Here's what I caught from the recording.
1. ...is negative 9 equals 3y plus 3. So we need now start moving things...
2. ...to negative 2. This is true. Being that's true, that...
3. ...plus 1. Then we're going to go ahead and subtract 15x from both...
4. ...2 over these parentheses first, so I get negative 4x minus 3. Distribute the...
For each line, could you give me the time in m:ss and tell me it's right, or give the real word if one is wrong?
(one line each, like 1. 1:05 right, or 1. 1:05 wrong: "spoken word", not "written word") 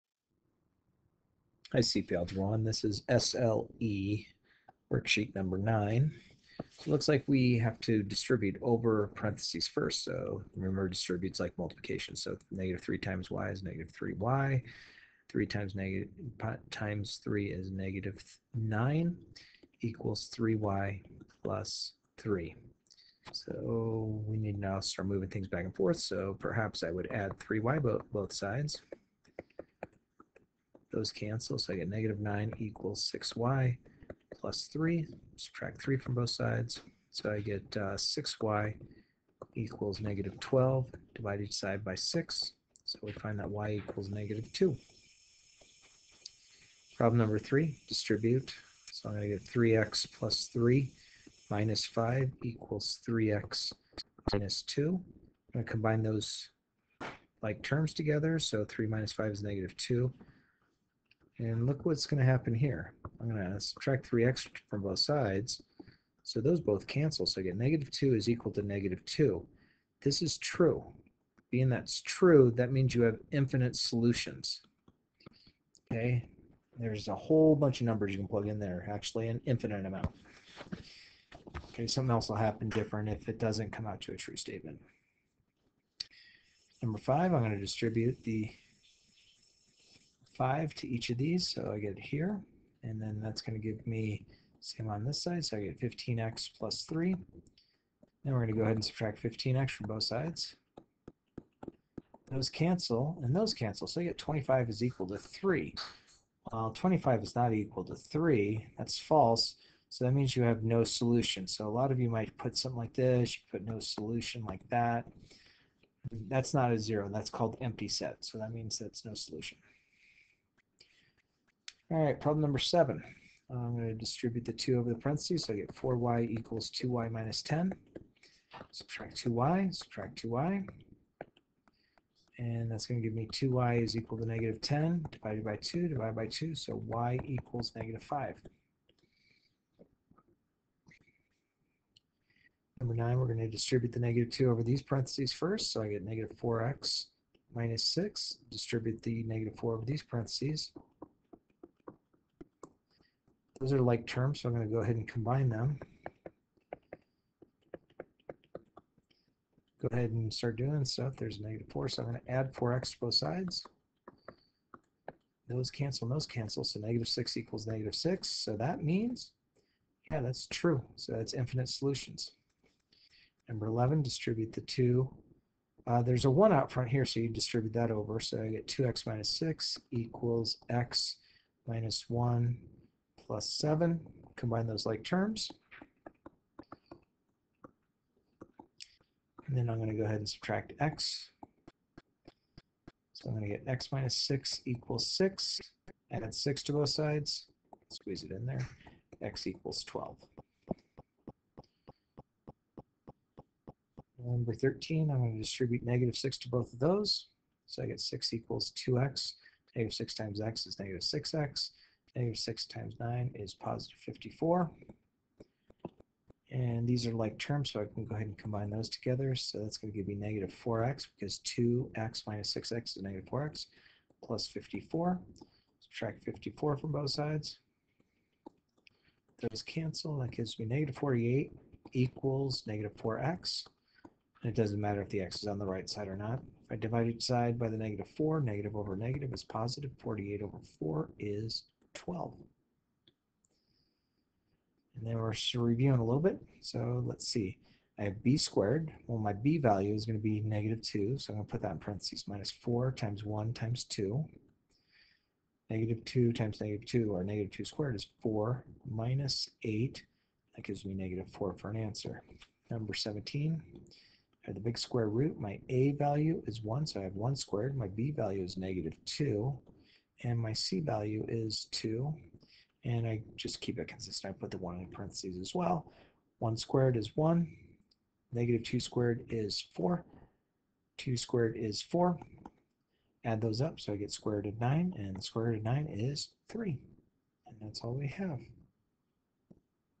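1. 0:17 right
2. 1:08 right
3. 1:36 wrong: "3", not "1"
4. 2:24 wrong: "6", not "3".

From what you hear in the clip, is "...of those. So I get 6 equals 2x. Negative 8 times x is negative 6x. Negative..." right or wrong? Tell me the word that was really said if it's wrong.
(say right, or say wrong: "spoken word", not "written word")
wrong: "6", not "8".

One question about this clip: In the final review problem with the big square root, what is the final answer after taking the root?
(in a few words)
3.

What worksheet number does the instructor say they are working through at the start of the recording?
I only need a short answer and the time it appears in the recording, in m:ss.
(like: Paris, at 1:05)
9, at 0:05.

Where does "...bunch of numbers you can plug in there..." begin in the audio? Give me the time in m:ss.
1:17.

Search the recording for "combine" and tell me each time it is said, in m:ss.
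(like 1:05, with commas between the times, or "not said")
0:55, 2:35, 3:04, 3:38.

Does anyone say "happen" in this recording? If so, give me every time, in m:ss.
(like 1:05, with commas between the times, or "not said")
1:02, 1:22.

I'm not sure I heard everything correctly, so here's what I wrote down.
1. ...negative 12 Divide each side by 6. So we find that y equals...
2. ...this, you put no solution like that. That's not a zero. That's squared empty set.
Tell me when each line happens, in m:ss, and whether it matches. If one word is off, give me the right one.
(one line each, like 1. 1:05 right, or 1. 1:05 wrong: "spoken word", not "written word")
1. 0:40 right
2. 1:52 wrong: "called", not "squared".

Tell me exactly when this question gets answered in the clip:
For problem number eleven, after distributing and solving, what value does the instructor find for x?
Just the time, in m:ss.
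3:19.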